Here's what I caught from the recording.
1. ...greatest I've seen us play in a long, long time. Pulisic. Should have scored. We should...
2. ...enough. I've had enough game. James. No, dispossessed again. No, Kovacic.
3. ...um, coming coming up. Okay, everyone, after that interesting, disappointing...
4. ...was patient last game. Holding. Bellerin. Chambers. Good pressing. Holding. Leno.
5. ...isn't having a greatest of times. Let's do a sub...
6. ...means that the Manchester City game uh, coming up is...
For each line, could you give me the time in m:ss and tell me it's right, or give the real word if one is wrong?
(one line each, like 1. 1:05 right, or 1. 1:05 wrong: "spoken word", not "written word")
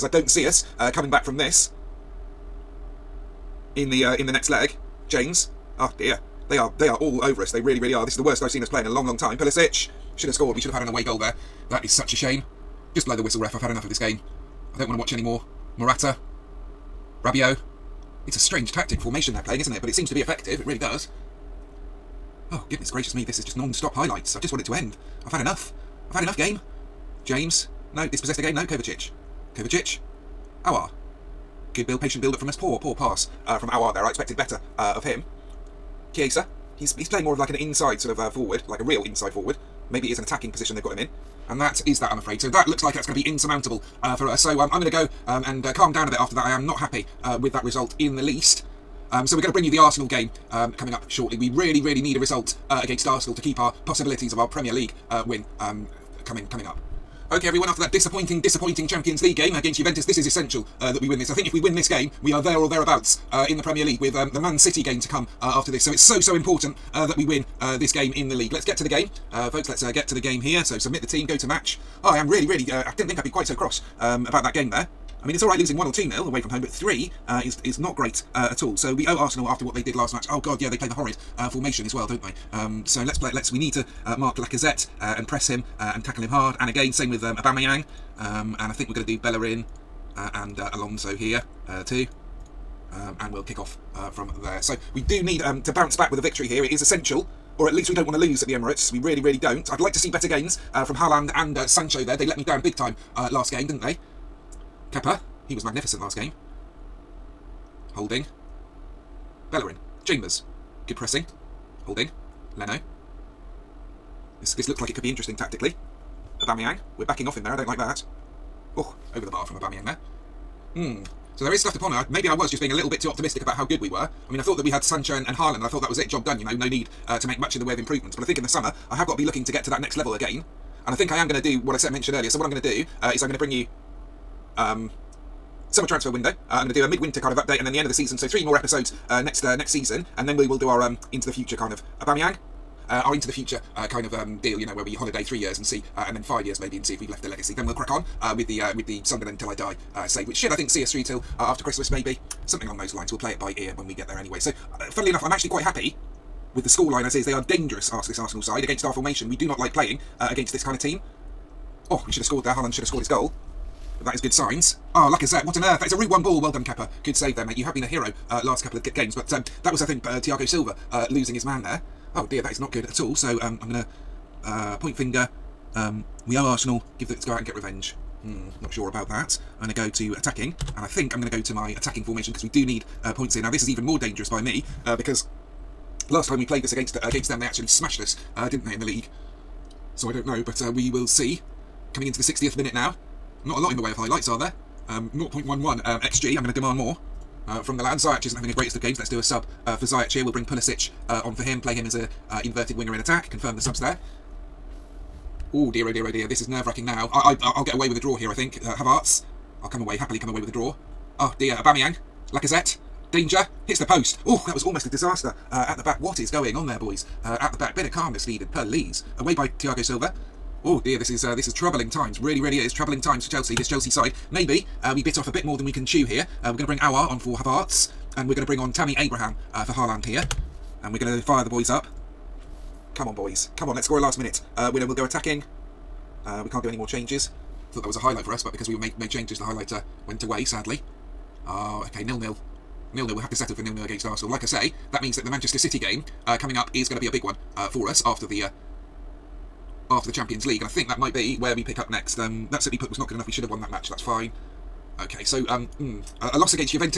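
1. 0:08 wrong: "worst", not "greatest"
2. 0:25 right
3. 0:55 wrong: "disappointing", not "interesting"
4. 1:45 wrong: "magnificent", not "patient"
5. 3:18 wrong: "games", not "times"
6. 4:05 right.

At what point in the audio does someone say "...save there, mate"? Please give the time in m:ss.
2:47.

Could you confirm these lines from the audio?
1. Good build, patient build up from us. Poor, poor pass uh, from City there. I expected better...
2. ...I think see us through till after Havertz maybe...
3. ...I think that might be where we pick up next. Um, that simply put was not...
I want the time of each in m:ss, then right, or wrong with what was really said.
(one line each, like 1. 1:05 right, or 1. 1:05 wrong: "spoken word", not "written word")
1. 0:31 wrong: "Aouar", not "City"
2. 2:30 wrong: "Christmas", not "Havertz"
3. 4:10 right.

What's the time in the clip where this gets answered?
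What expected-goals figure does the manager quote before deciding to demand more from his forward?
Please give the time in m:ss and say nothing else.
3:15.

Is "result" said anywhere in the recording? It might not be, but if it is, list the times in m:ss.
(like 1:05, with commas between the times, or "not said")
0:47, 0:52.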